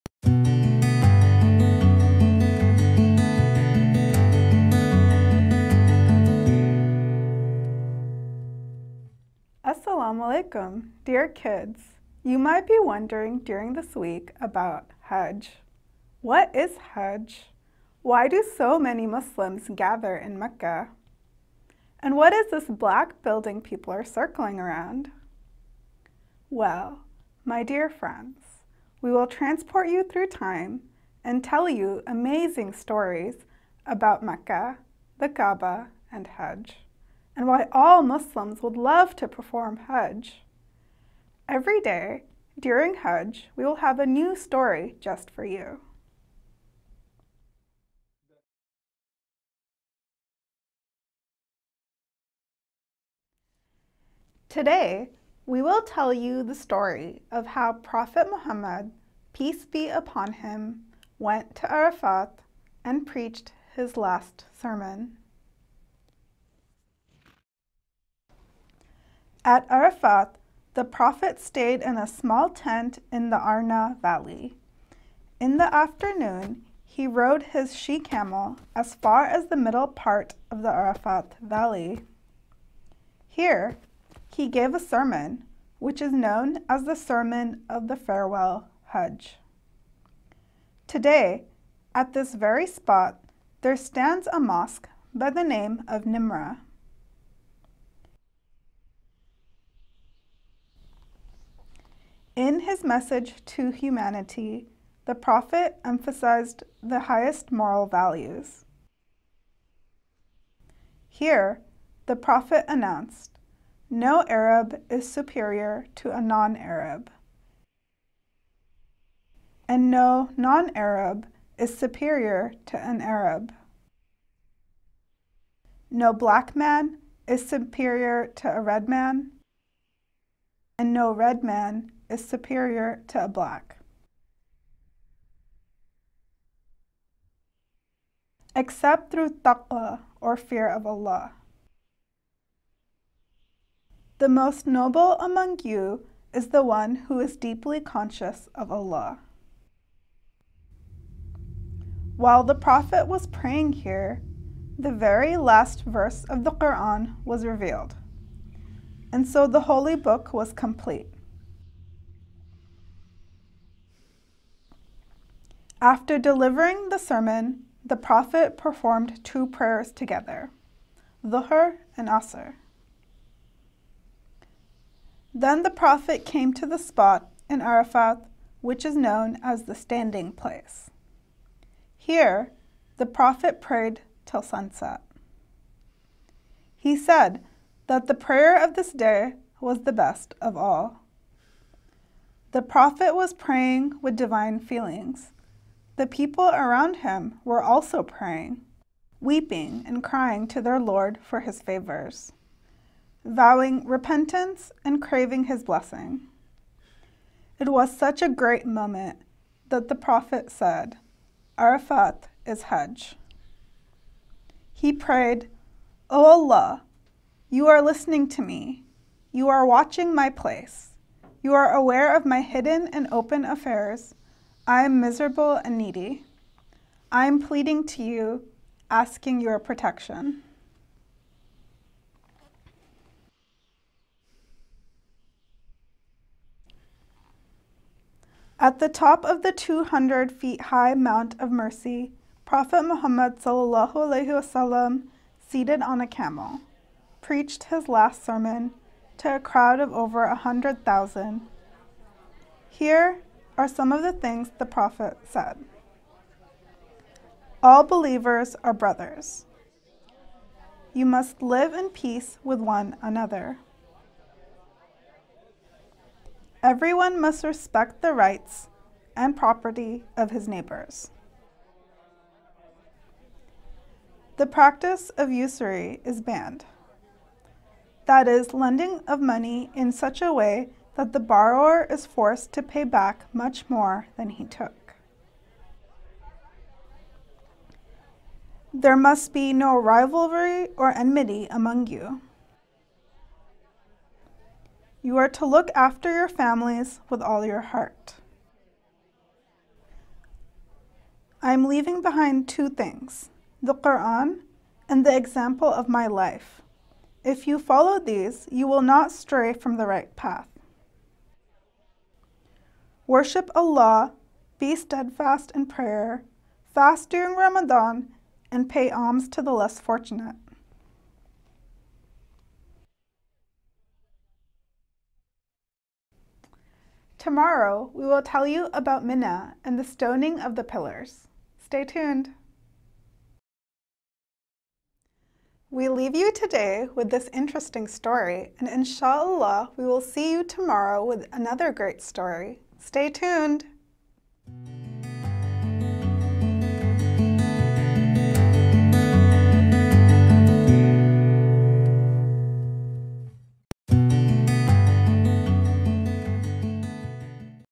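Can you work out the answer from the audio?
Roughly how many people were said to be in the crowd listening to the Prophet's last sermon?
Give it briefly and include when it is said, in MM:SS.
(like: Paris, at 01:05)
over 100,000, at 04:09.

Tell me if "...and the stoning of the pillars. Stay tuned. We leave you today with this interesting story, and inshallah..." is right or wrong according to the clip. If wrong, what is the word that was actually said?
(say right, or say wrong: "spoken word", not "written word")
right.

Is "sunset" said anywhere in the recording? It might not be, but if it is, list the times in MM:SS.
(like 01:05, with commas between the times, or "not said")
03:04.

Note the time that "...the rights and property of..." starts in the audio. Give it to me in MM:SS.
04:28.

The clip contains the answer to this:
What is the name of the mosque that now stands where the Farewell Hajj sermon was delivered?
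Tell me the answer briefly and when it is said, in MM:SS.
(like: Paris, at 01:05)
Nimra, at 01:36.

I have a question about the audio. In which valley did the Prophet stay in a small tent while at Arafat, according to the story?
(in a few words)
Arna Valley.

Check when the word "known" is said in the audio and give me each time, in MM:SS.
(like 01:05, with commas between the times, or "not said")
01:26, 02:58.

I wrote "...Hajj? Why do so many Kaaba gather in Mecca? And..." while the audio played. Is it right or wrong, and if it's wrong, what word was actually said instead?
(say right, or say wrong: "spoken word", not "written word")
wrong: "Muslims", not "Kaaba".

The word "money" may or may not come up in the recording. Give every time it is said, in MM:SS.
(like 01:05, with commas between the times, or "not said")
04:39.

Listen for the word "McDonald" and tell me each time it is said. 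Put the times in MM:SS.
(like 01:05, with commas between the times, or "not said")
not said.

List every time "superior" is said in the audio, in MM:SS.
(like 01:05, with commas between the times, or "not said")
01:55, 02:01, 02:07, 02:12.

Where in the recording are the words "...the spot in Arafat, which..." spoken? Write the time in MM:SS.
02:56.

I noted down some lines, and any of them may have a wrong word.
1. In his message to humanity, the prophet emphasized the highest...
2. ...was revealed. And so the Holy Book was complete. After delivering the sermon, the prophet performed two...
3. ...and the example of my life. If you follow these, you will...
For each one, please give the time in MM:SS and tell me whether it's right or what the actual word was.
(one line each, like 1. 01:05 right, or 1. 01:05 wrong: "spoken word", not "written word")
1. 01:42 right
2. 02:37 right
3. 05:04 right.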